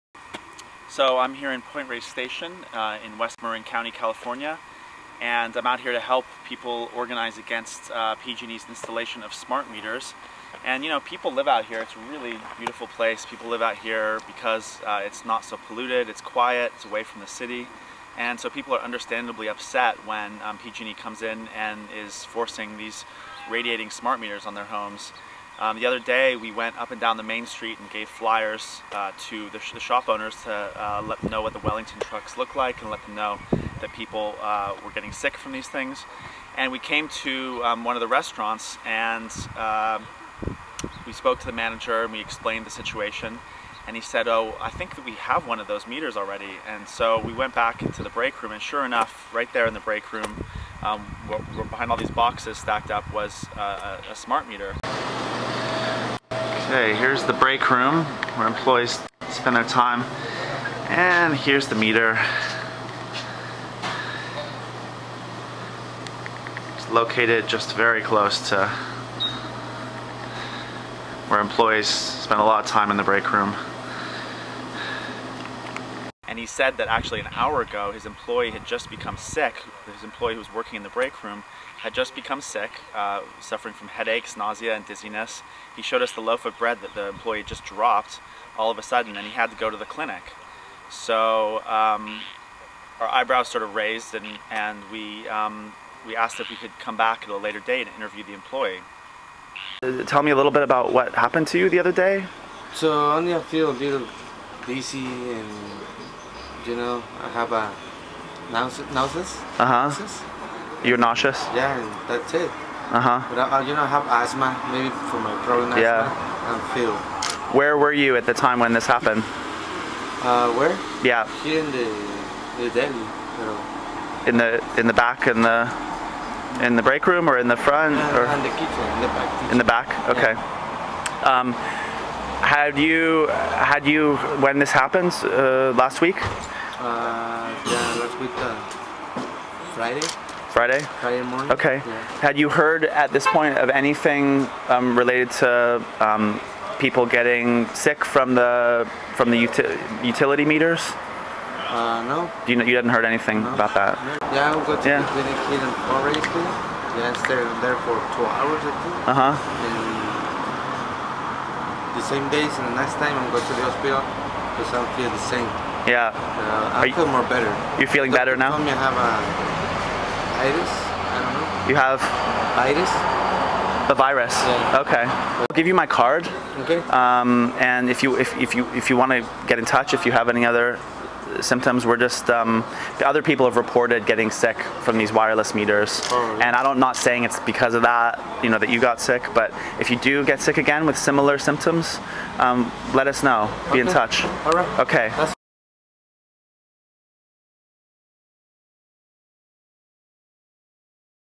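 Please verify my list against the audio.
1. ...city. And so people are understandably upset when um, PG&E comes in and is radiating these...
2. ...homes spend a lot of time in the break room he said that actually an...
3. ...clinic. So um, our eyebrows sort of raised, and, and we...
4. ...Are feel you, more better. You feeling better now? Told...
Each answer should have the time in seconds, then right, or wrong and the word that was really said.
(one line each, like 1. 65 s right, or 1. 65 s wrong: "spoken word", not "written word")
1. 17 s wrong: "forcing", not "radiating"
2. 71 s wrong: "employees", not "homes"
3. 89 s right
4. 166 s right.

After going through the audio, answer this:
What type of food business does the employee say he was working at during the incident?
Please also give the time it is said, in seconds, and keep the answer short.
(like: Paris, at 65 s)
the deli, at 122 s.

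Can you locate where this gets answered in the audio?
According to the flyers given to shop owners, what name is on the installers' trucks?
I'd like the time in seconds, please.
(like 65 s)
31 s.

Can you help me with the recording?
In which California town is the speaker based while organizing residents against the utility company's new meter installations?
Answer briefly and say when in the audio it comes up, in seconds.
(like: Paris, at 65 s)
Point Reyes Station, at 1 s.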